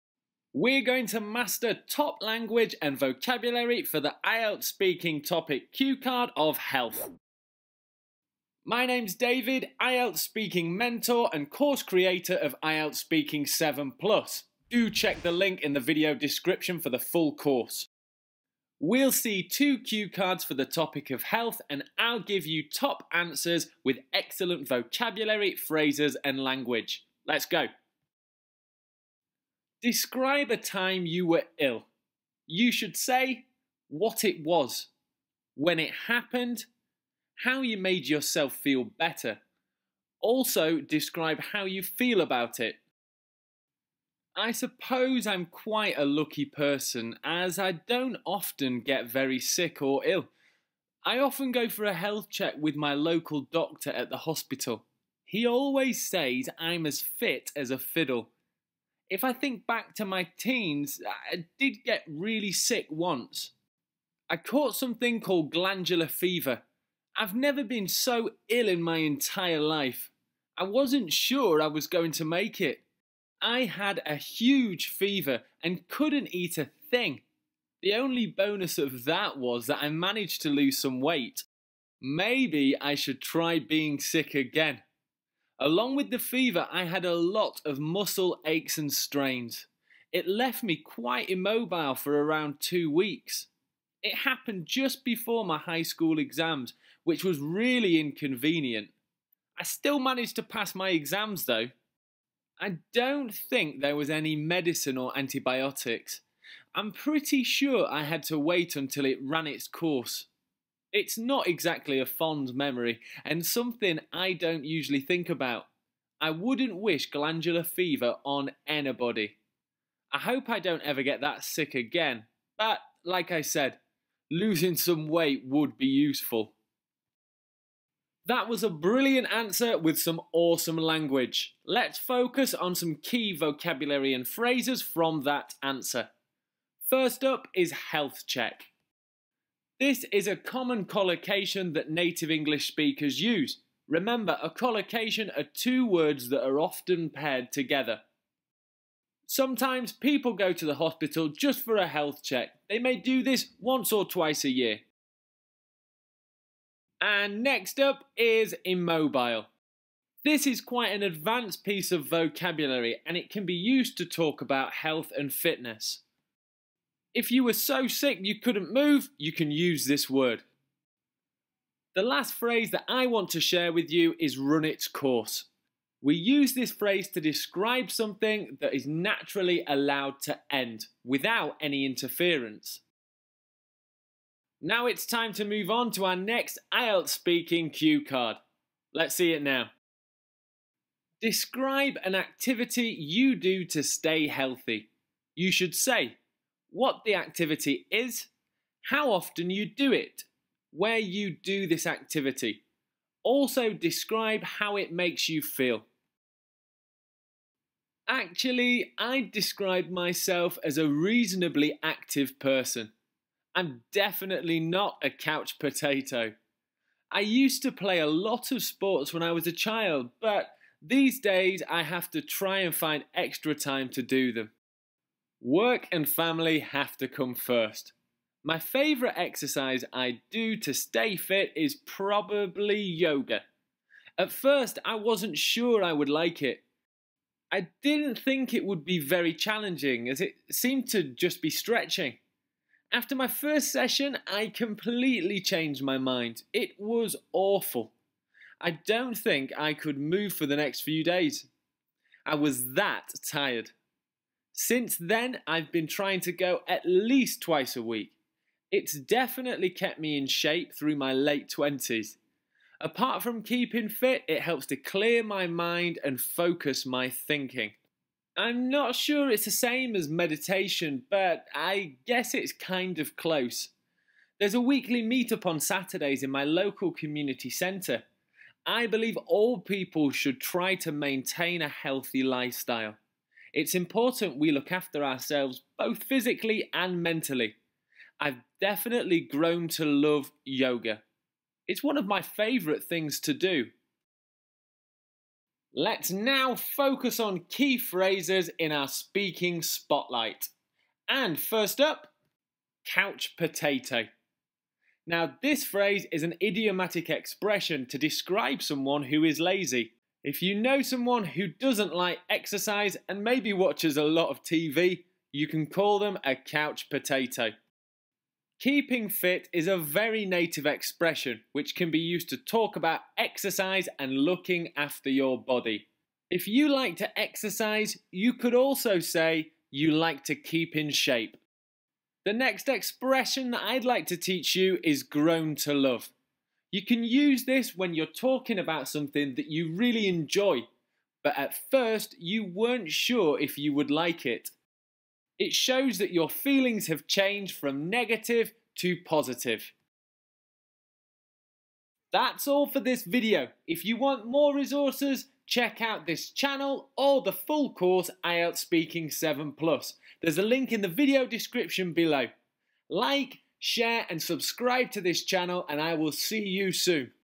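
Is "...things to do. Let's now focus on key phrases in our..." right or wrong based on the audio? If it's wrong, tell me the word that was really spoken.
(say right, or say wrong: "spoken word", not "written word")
right.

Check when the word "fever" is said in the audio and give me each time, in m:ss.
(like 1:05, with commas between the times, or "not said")
1:06, 1:14, 1:26, 1:57.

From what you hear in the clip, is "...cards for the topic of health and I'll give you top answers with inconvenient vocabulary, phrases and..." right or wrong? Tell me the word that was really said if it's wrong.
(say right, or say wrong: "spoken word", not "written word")
wrong: "excellent", not "inconvenient".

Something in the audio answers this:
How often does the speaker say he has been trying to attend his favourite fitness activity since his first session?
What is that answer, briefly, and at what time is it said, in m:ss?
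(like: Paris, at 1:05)
at least twice a week, at 4:16.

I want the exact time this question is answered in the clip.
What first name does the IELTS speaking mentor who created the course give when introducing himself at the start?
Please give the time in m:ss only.
0:09.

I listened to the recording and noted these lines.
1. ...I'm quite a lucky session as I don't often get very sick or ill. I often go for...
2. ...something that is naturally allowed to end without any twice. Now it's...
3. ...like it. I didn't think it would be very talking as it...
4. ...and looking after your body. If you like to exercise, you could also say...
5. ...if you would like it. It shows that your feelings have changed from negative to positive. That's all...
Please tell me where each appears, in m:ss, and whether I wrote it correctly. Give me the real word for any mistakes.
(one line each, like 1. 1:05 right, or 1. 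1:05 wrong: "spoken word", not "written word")
1. 0:45 wrong: "person", not "session"
2. 2:57 wrong: "interference", not "twice"
3. 3:56 wrong: "challenging", not "talking"
4. 5:23 right
5. 5:43 right.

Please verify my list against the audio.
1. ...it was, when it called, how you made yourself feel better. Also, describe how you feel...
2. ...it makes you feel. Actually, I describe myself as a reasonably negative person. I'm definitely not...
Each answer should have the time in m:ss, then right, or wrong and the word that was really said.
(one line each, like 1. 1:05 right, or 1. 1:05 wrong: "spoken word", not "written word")
1. 0:34 wrong: "happened", not "called"
2. 3:24 wrong: "active", not "negative".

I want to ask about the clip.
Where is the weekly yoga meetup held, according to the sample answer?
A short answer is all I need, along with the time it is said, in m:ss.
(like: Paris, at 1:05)
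local community centre, at 4:36.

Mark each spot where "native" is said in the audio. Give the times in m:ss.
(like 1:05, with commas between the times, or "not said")
2:21, 5:20.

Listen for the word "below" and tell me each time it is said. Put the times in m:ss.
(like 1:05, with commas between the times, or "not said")
6:01.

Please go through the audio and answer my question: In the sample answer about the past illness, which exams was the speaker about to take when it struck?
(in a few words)
high school exams.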